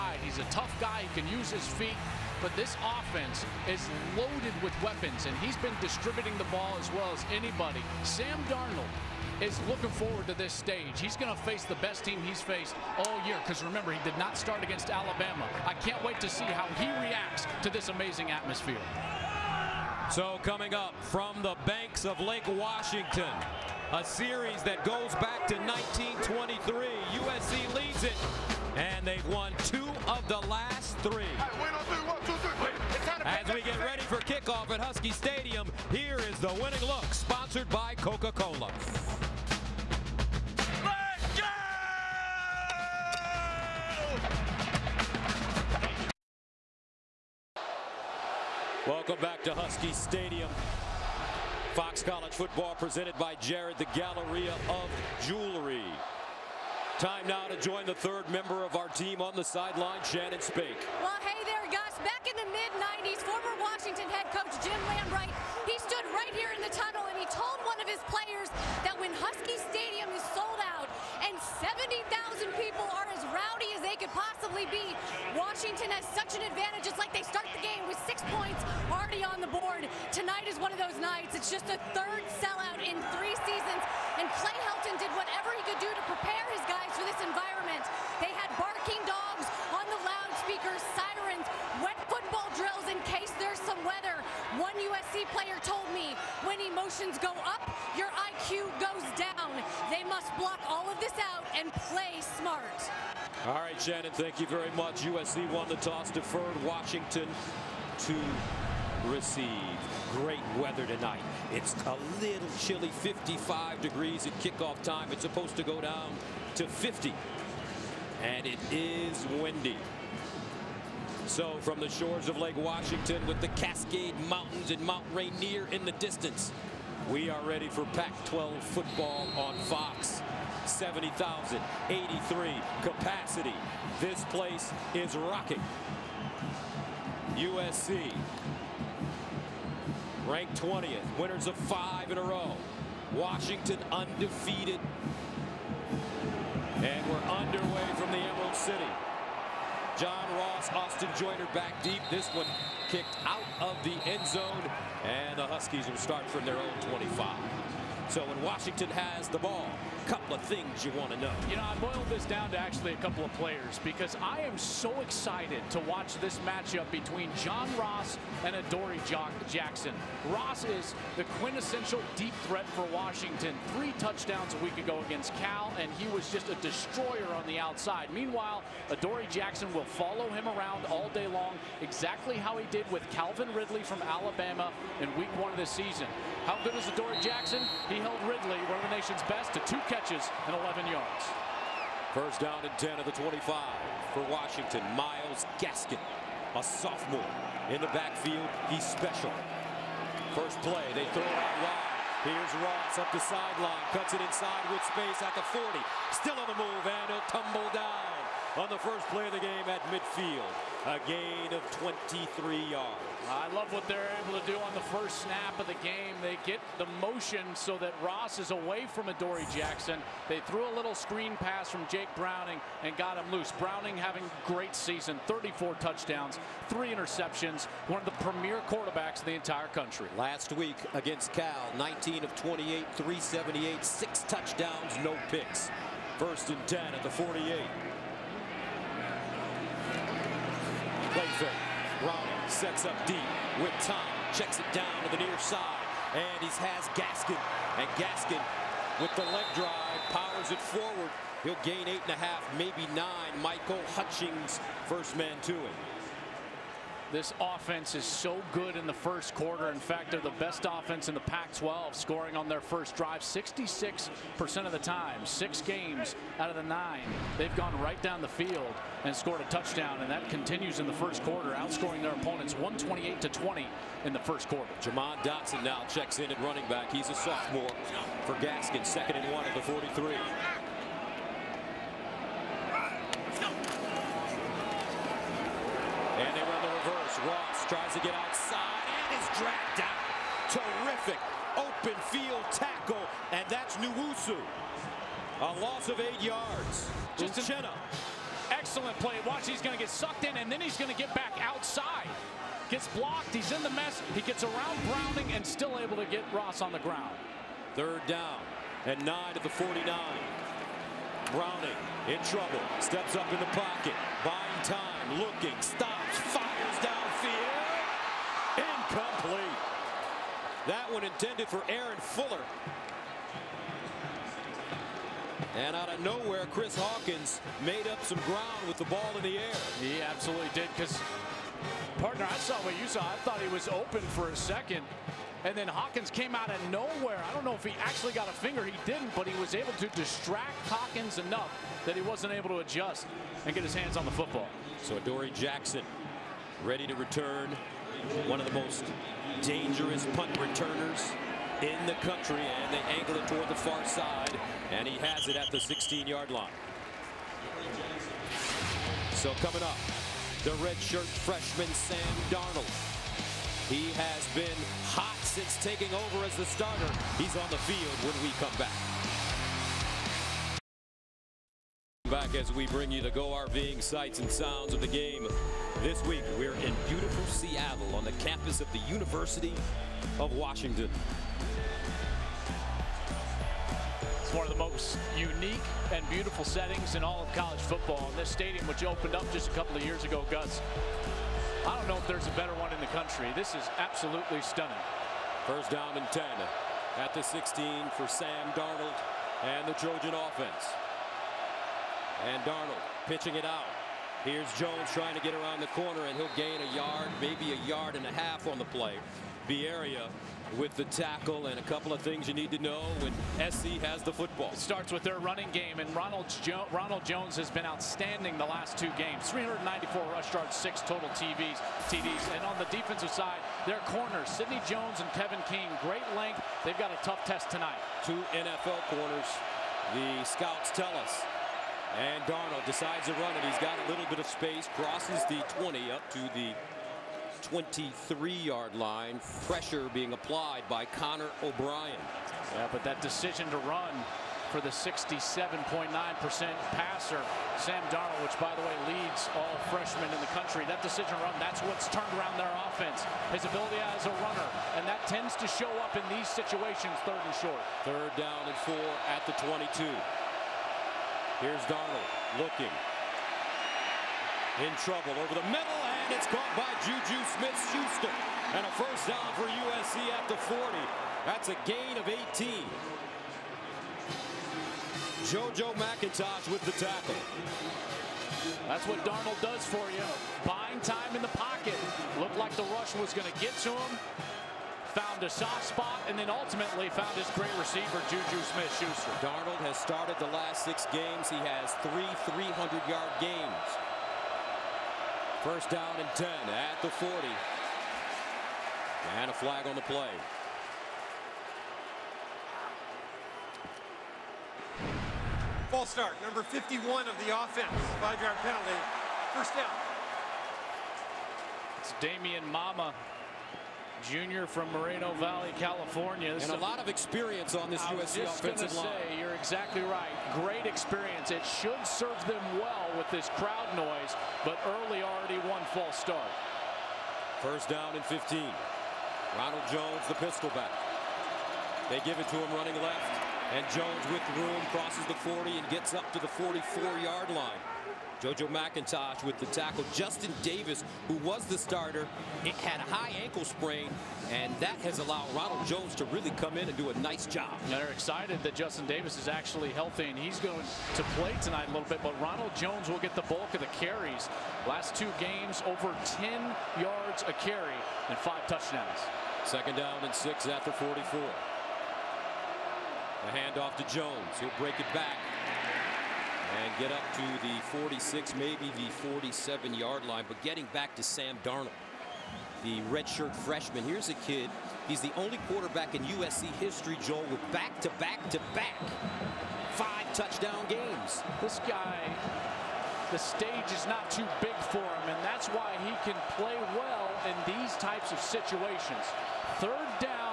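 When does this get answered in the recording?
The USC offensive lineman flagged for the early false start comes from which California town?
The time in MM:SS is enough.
08:34.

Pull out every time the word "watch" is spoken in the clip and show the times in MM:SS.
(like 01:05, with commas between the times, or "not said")
02:45, 04:59.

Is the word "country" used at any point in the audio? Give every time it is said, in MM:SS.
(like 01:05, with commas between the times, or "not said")
03:49, 05:51, 06:32, 07:30.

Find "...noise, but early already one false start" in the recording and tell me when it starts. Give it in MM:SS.
08:43.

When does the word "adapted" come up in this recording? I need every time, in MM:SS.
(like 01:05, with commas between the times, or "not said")
not said.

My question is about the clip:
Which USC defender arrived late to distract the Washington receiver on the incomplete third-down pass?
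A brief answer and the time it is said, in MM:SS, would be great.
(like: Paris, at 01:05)
Chris Hawkins, at 05:26.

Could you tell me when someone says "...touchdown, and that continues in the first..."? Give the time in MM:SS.
04:29.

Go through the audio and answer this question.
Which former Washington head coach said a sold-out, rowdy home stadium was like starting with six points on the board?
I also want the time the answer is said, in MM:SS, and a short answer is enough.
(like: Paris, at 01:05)
Jim Lambright, at 01:04.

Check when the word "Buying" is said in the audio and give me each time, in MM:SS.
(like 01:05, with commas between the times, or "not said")
05:14, 08:00.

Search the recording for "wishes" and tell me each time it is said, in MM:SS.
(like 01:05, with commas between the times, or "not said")
not said.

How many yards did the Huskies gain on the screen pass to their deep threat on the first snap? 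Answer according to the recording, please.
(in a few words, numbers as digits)
23.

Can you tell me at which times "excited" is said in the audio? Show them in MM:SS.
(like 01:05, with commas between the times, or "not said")
02:44, 09:07.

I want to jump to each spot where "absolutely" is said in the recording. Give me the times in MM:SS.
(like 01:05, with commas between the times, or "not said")
05:30, 06:33.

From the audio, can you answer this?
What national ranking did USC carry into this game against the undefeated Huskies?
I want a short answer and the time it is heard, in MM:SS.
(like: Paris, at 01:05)
20th, at 02:20.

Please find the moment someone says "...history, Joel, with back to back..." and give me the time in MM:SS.
09:36.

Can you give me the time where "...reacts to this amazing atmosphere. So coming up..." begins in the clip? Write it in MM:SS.
00:17.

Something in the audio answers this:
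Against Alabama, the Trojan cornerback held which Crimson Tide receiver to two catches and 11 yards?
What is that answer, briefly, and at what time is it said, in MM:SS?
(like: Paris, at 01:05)
Calvin Ridley, at 03:03.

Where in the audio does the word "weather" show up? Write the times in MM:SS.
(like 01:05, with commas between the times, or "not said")
01:33, 01:50.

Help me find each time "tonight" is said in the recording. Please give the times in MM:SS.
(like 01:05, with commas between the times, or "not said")
01:20, 01:50, 07:07, 09:11.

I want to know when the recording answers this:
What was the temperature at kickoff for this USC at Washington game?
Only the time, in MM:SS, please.
01:52.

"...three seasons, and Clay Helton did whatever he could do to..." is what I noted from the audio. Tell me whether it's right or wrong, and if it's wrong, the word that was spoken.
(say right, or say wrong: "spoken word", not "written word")
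right.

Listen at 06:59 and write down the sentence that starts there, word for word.
394 rush yards, six total TVs, TDs.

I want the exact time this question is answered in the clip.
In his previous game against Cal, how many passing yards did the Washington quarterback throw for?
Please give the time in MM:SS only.
03:52.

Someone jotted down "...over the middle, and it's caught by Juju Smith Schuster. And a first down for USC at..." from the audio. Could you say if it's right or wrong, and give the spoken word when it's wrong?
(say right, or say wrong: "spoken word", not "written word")
right.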